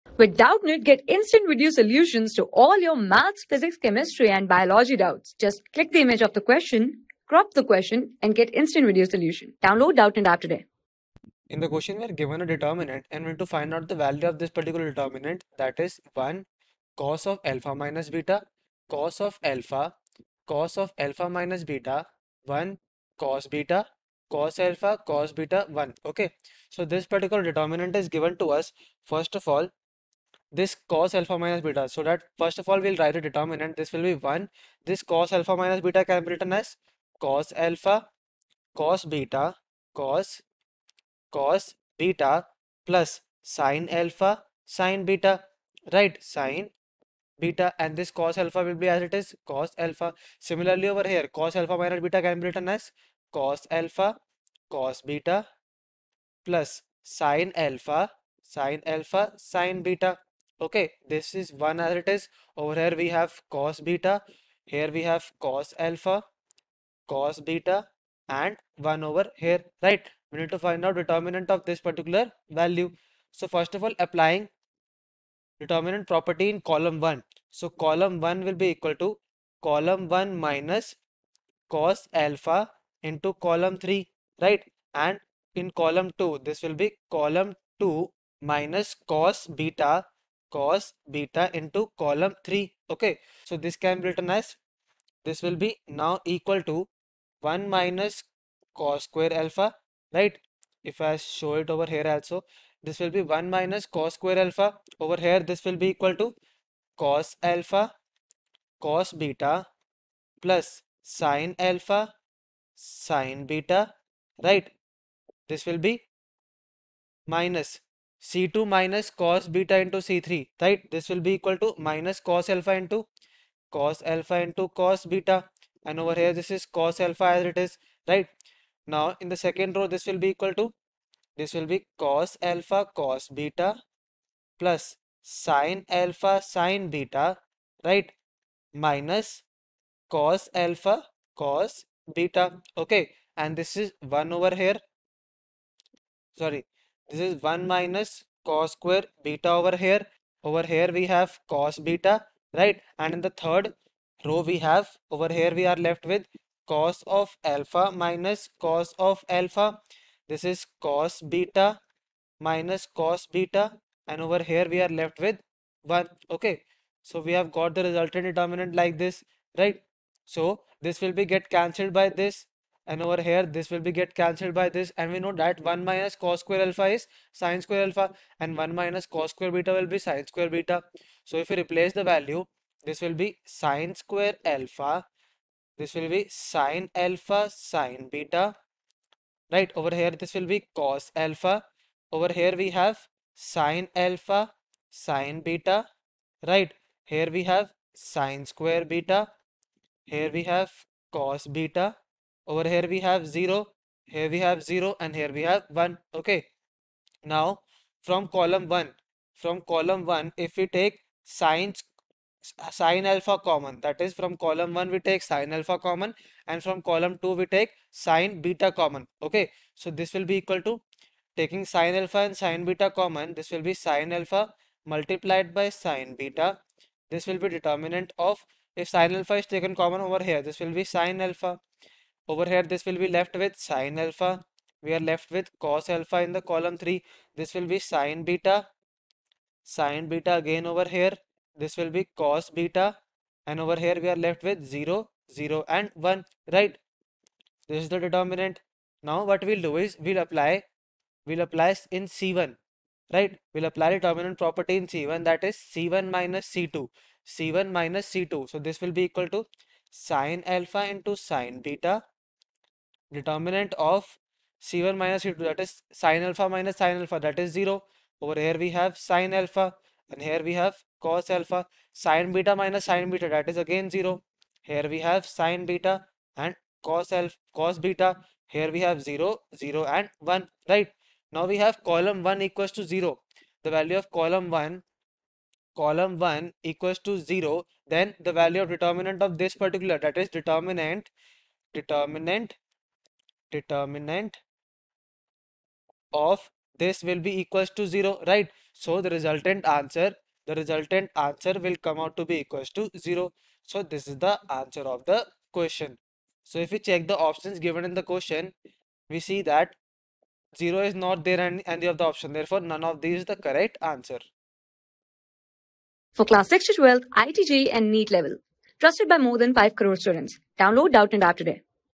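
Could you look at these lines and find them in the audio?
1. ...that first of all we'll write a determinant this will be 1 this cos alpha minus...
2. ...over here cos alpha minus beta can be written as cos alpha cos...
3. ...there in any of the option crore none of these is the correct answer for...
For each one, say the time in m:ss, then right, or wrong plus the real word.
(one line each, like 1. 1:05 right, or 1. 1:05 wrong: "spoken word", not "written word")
1. 0:32 right
2. 0:50 right
3. 5:11 wrong: "therefore", not "crore".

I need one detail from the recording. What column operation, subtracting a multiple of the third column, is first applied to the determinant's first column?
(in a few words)
C1 - cos alpha × C3.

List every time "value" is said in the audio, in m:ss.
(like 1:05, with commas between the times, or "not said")
0:13, 1:12, 3:02, 4:43, 4:48.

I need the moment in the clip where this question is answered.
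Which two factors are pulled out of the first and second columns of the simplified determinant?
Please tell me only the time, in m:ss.
3:41.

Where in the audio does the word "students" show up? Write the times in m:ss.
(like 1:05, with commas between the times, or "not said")
5:20.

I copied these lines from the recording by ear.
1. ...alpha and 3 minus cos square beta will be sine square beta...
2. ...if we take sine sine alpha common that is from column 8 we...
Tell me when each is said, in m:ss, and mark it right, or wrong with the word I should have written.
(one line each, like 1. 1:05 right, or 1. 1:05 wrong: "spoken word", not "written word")
1. 2:57 wrong: "1", not "3"
2. 3:30 wrong: "1", not "8".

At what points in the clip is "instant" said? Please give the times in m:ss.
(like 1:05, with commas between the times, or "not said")
0:01, 0:08.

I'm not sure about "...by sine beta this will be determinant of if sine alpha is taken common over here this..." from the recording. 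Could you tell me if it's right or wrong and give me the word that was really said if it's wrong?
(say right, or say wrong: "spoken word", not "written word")
right.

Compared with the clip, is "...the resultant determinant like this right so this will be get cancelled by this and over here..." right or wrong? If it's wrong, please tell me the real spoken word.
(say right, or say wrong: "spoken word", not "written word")
right.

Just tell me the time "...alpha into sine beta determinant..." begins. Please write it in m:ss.
4:20.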